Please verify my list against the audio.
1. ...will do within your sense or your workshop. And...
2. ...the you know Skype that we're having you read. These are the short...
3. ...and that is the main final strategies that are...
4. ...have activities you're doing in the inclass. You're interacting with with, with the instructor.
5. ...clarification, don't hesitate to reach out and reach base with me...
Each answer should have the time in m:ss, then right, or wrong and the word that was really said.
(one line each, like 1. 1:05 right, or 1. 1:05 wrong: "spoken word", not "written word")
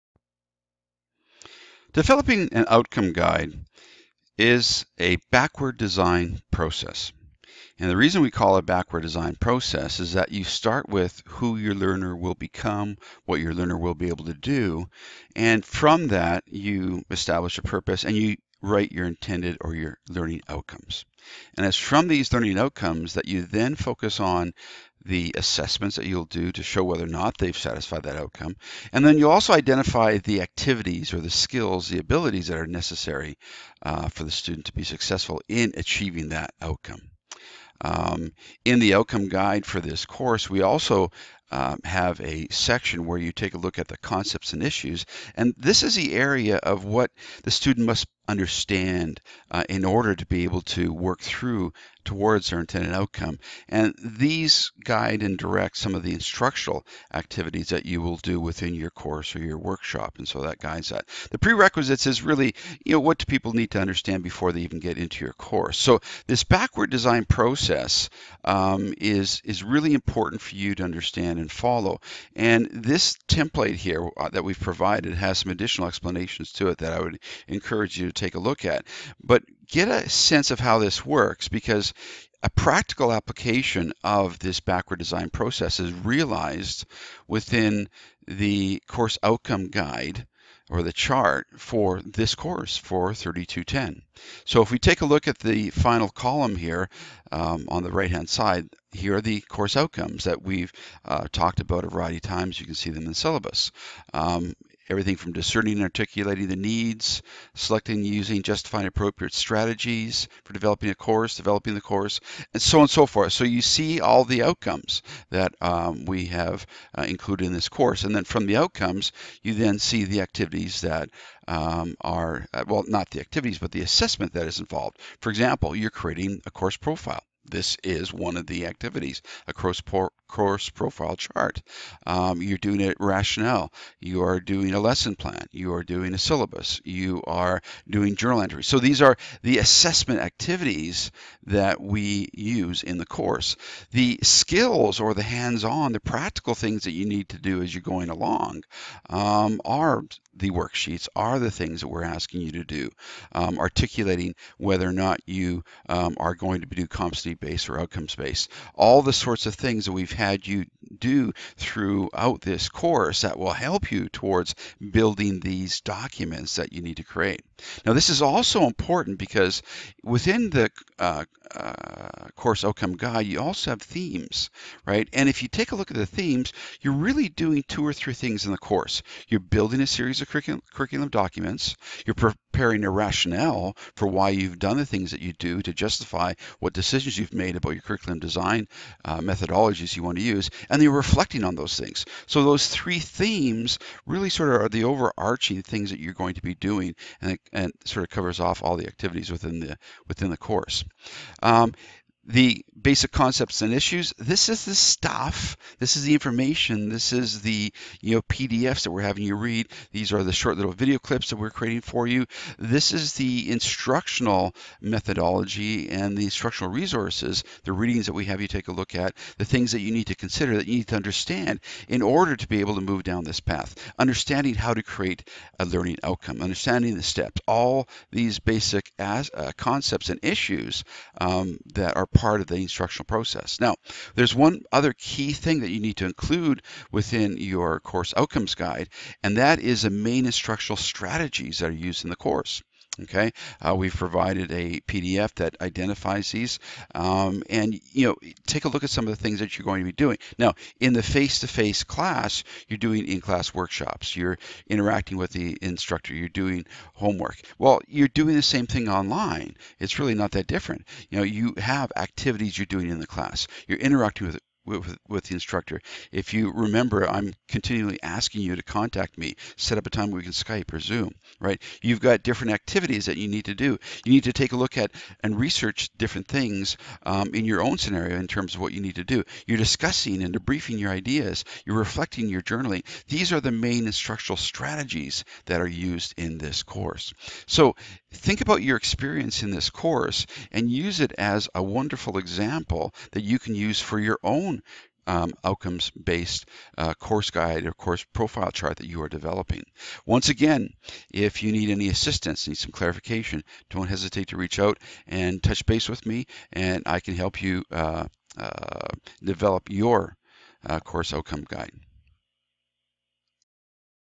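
1. 0:58 wrong: "course", not "sense"
2. 3:27 wrong: "PDFs", not "Skype"
3. 3:59 wrong: "instructional", not "final"
4. 4:21 wrong: "class", not "inclass"
5. 5:02 wrong: "touch", not "reach".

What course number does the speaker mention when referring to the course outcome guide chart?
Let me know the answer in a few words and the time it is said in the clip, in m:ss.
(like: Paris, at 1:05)
3210, at 1:33.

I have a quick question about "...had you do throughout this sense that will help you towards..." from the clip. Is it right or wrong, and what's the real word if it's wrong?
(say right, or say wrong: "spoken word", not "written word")
wrong: "course", not "sense".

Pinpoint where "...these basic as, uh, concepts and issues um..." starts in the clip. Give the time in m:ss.
3:48.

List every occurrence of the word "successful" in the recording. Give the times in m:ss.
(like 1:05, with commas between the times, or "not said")
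0:34.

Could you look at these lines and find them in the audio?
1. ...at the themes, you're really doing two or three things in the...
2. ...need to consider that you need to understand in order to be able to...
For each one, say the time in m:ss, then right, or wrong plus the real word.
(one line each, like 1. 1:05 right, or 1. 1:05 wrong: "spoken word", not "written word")
1. 2:55 right
2. 3:39 right.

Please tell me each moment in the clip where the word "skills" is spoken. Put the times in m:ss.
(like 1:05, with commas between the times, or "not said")
0:31, 2:24.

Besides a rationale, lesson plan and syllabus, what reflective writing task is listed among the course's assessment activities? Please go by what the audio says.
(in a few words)
journal entries.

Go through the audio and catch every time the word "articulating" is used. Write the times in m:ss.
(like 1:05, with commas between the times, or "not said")
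1:45, 2:33.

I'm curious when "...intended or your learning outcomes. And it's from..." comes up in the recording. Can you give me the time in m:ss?
0:19.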